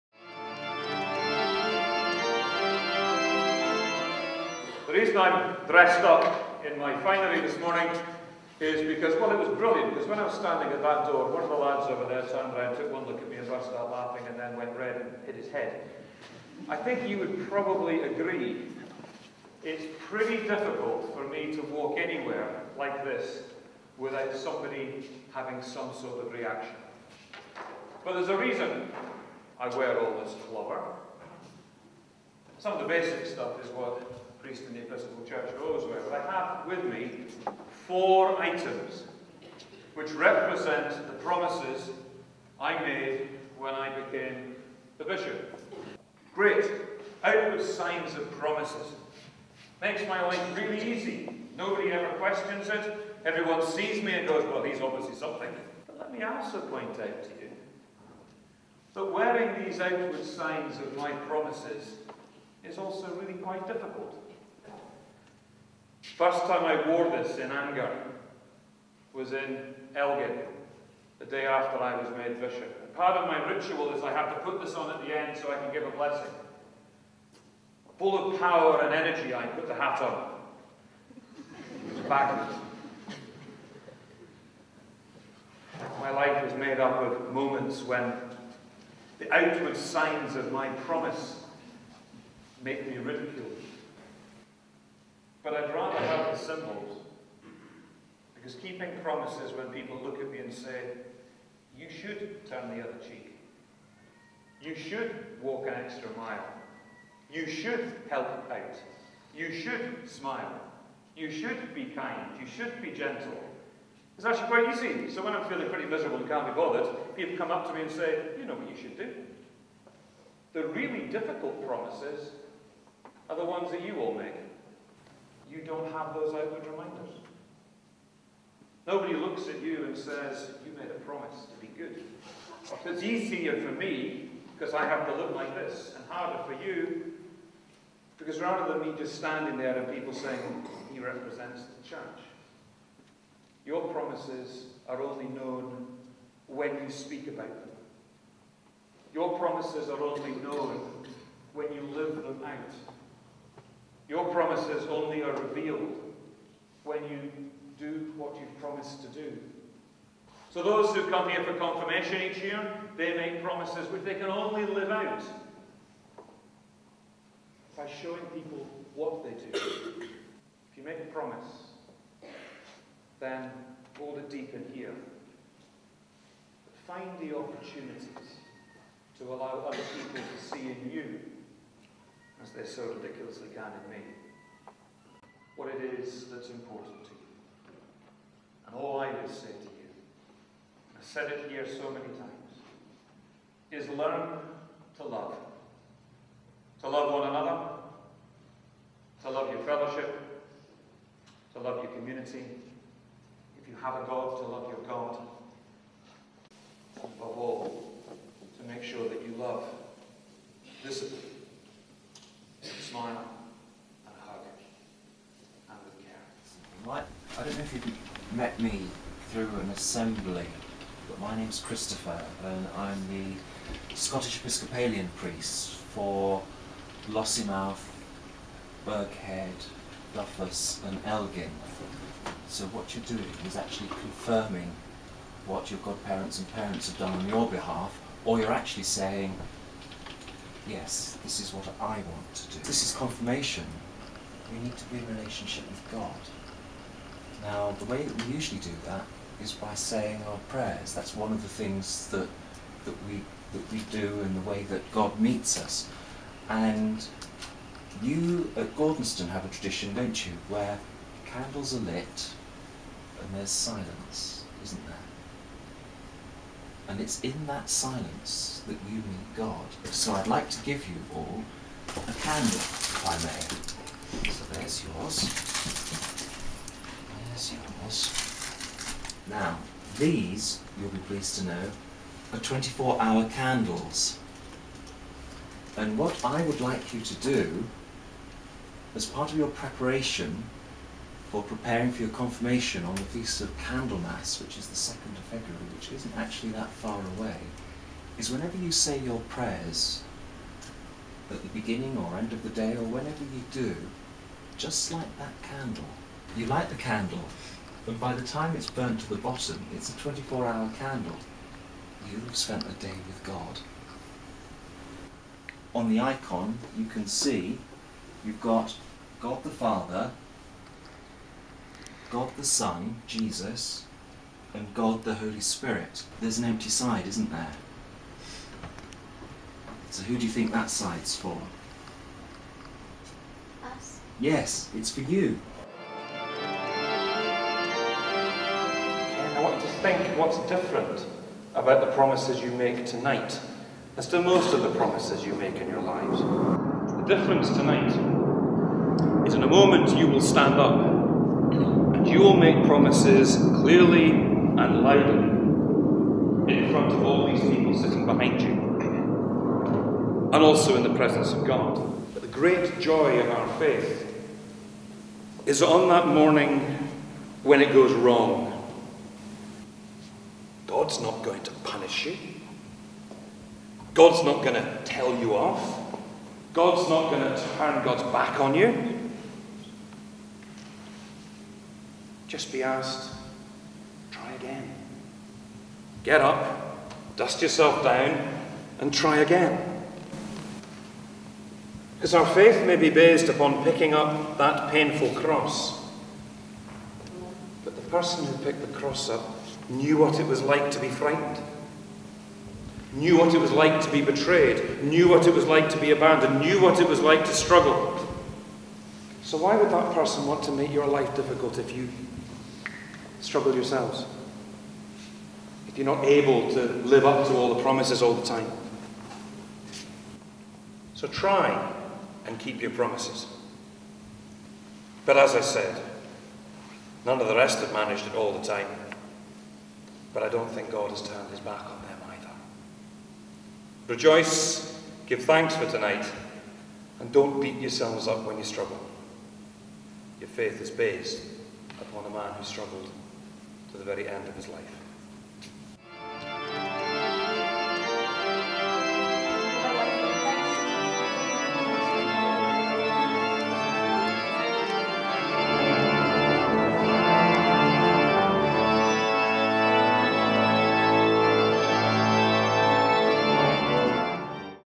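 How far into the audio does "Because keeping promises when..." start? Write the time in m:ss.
1:38.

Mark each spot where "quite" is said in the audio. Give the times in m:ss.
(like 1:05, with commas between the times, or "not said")
1:03, 1:54.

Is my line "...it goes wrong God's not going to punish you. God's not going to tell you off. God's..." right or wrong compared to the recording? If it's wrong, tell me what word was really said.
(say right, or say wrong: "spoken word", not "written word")
right.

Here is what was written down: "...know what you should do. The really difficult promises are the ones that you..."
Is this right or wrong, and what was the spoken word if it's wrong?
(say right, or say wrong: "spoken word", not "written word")
right.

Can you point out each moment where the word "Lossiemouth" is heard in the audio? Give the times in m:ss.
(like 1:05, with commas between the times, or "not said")
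3:47.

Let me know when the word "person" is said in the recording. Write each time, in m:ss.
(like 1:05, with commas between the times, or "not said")
6:37, 6:49.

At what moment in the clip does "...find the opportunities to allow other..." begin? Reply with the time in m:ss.
2:56.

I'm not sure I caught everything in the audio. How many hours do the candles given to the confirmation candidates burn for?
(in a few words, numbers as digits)
24.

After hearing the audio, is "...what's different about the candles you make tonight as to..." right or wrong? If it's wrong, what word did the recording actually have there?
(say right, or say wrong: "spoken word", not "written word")
wrong: "promises", not "candles".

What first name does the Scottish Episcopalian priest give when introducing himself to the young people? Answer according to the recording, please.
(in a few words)
Christopher.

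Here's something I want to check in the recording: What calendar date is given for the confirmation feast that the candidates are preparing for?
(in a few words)
2 February.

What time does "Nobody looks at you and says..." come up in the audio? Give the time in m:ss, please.
2:08.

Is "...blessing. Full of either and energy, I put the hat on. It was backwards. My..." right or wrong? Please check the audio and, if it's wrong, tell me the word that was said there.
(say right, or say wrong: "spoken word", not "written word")
wrong: "power", not "either".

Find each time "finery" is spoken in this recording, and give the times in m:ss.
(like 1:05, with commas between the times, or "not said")
0:06.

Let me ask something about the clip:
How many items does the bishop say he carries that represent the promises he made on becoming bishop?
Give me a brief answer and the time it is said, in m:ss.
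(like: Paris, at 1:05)
4, at 0:37.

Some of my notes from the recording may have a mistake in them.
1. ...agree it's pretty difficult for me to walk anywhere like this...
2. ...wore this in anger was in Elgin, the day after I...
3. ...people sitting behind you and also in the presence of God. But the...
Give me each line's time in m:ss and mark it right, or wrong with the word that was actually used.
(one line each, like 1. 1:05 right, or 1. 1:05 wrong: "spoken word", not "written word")
1. 0:18 right
2. 1:06 right
3. 5:57 right.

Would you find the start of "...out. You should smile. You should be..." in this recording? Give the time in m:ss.
1:48.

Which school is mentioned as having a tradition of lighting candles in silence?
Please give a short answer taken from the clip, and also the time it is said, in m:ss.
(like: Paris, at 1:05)
Gordonstoun, at 4:18.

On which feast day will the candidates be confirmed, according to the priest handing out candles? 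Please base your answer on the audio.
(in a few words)
Candlemas.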